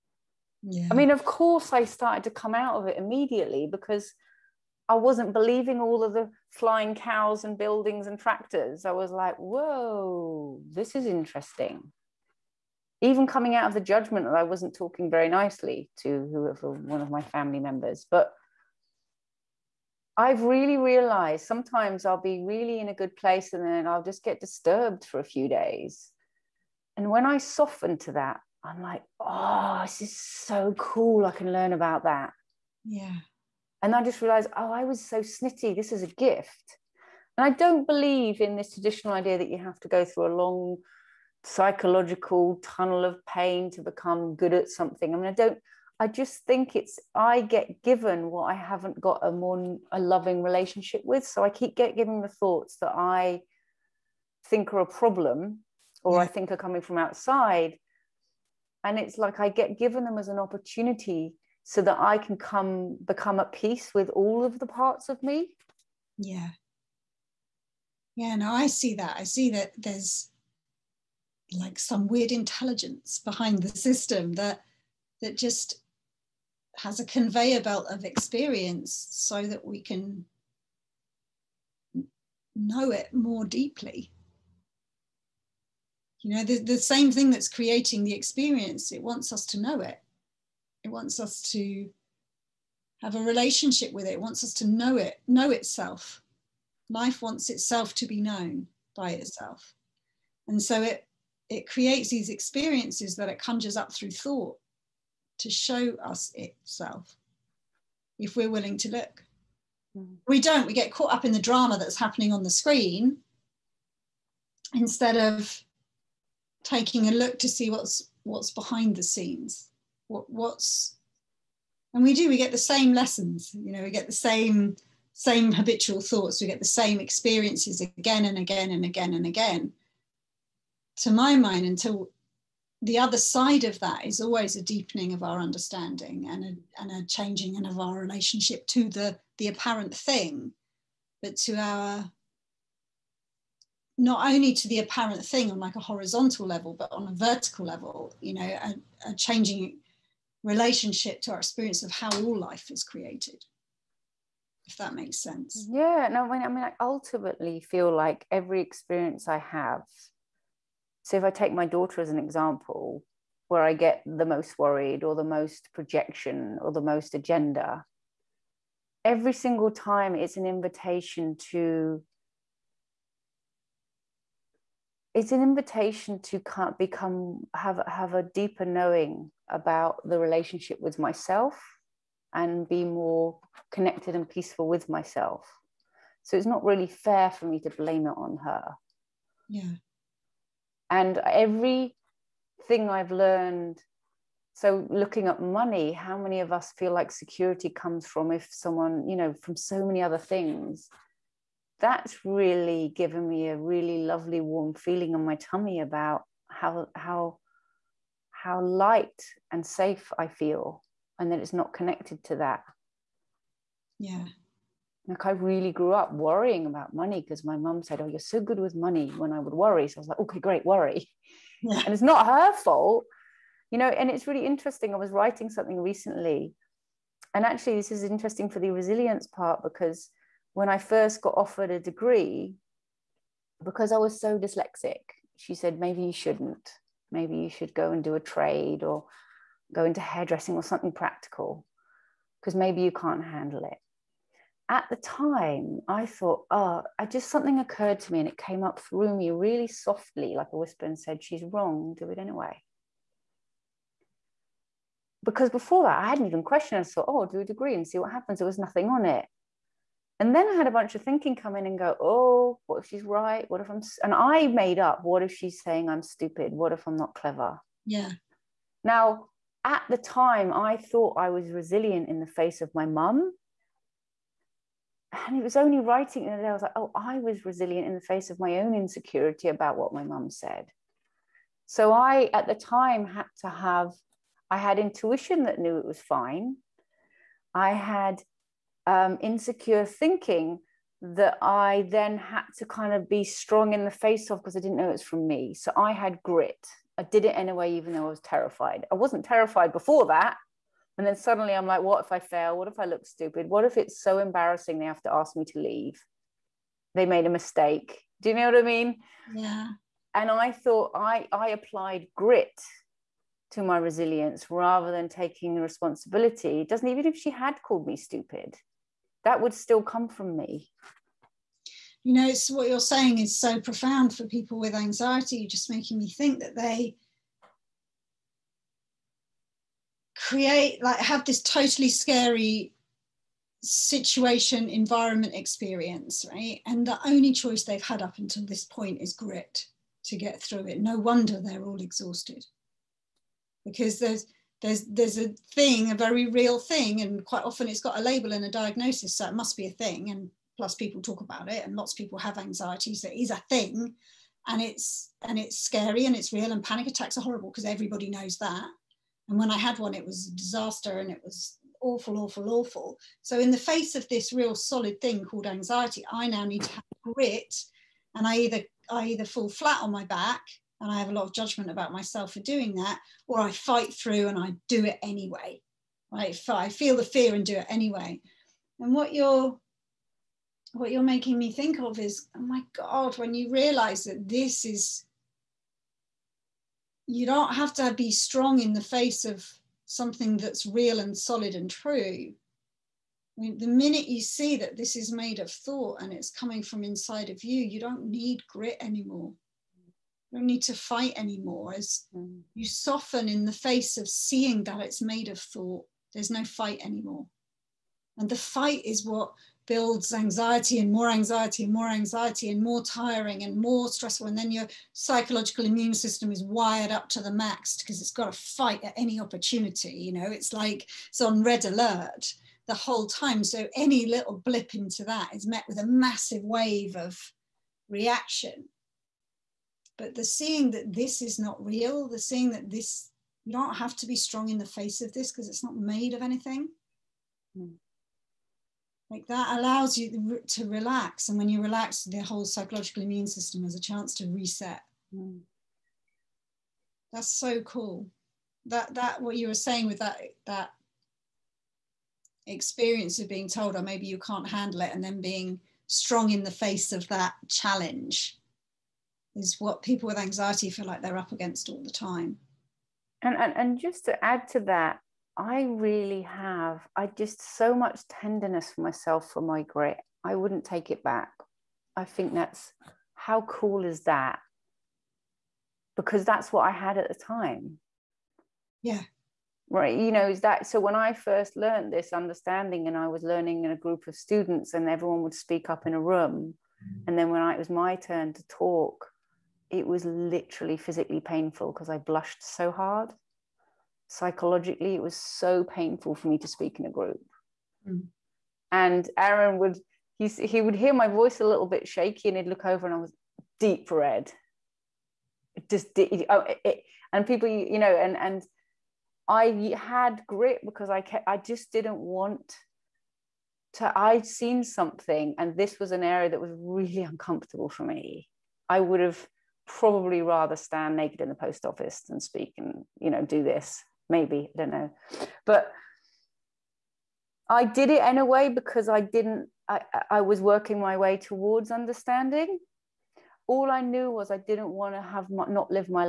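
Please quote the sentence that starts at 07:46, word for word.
I just so much tenderness for myself for my grit.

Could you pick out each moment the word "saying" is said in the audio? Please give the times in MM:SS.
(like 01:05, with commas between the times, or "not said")
04:25, 05:22, 07:29.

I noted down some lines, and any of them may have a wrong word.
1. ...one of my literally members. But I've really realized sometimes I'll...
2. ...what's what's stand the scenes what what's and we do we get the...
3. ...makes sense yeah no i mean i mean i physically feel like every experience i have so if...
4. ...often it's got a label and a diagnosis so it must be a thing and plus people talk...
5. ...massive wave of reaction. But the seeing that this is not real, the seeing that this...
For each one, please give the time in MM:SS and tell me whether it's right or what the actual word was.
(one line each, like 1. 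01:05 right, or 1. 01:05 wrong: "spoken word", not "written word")
1. 00:16 wrong: "family", not "literally"
2. 01:57 wrong: "behind", not "stand"
3. 02:34 wrong: "ultimately", not "physically"
4. 05:47 right
5. 07:05 right.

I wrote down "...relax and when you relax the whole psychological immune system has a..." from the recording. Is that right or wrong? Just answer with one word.
right.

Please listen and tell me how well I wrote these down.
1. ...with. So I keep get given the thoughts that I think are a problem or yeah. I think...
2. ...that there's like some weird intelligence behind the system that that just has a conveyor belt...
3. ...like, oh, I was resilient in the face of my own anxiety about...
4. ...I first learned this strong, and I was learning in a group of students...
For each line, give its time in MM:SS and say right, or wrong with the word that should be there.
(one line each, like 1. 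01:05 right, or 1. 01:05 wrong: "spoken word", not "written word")
1. 00:51 right
2. 01:09 right
3. 04:36 wrong: "insecurity", not "anxiety"
4. 08:00 wrong: "understanding", not "strong".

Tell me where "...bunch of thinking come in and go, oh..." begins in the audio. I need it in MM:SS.
04:20.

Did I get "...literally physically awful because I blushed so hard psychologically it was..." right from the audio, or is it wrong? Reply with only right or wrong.
wrong.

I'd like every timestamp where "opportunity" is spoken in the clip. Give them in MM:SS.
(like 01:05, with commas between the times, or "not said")
01:00, 06:59.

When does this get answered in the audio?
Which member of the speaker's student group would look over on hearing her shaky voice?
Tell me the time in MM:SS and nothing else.
08:19.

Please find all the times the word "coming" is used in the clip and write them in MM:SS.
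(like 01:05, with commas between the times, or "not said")
00:13, 00:56, 06:36.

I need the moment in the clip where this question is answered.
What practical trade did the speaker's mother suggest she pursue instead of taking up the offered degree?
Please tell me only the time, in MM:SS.
04:00.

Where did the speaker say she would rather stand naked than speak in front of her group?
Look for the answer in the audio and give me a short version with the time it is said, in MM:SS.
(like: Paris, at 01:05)
The post office, at 08:41.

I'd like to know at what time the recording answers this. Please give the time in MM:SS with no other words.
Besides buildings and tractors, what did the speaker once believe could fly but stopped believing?
00:06.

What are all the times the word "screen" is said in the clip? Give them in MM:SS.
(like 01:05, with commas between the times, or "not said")
01:52.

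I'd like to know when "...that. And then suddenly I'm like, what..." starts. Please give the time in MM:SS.
05:00.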